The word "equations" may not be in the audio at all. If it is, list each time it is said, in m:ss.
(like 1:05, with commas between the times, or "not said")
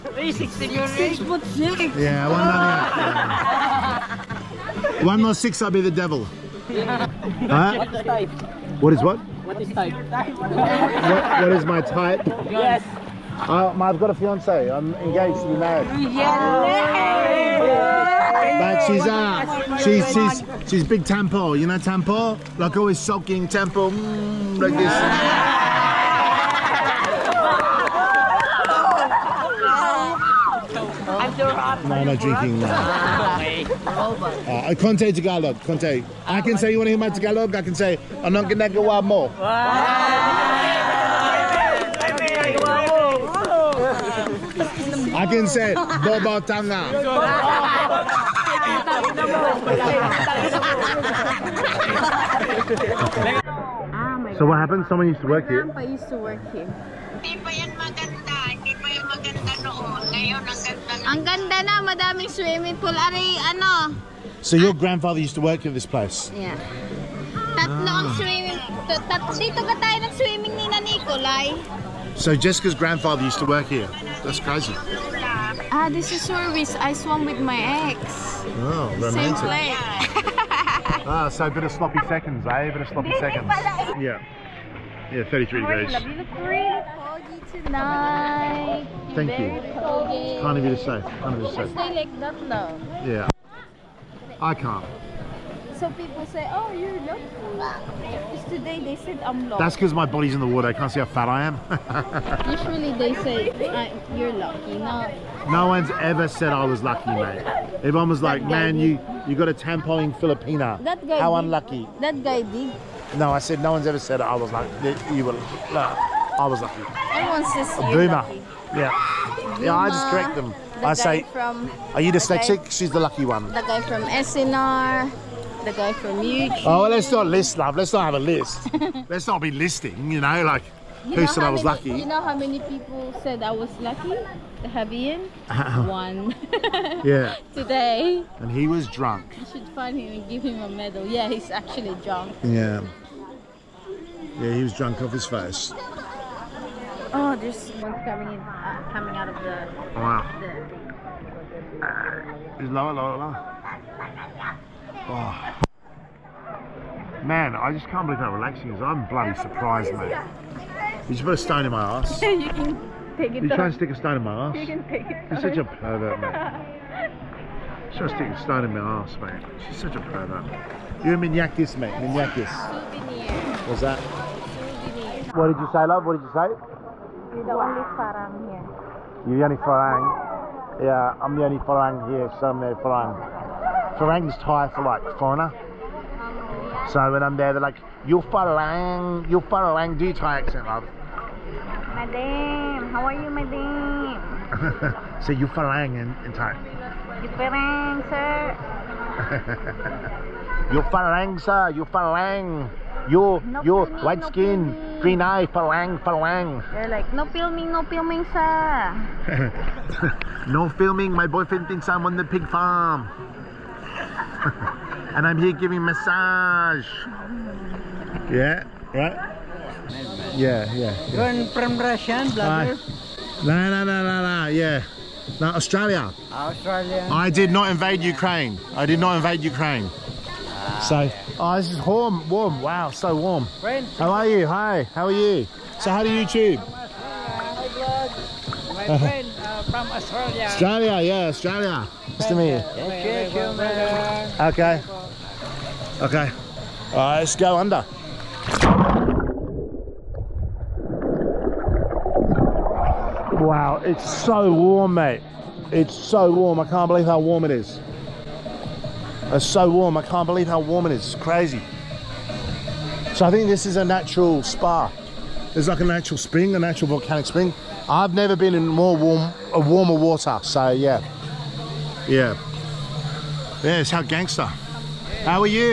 not said.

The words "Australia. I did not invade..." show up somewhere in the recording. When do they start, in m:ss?
3:46.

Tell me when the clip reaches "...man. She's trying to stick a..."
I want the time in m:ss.
2:46.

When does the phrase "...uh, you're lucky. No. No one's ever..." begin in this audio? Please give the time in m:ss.
1:43.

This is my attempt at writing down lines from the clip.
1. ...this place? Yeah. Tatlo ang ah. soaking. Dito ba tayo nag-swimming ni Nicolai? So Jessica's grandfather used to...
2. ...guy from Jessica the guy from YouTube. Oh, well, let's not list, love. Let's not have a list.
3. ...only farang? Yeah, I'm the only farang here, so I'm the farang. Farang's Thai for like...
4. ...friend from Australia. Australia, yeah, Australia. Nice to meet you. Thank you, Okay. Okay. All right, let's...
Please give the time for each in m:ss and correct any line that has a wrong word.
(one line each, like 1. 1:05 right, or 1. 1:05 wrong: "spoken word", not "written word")
1. 1:05 wrong: "swimming", not "soaking"
2. 2:03 wrong: "SNR", not "Jessica"
3. 2:59 right
4. 3:58 right.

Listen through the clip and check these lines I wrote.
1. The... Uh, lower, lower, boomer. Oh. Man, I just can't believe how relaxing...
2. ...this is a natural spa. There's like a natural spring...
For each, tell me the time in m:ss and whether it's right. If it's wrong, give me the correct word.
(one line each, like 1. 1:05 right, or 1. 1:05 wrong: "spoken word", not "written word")
1. 2:32 wrong: "lower", not "boomer"
2. 4:23 right.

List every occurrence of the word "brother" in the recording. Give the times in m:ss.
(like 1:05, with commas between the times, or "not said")
3:42.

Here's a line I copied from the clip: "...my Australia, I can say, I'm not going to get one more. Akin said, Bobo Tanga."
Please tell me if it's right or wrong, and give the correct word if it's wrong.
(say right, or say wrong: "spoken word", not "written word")
wrong: "Tagalog", not "Australia".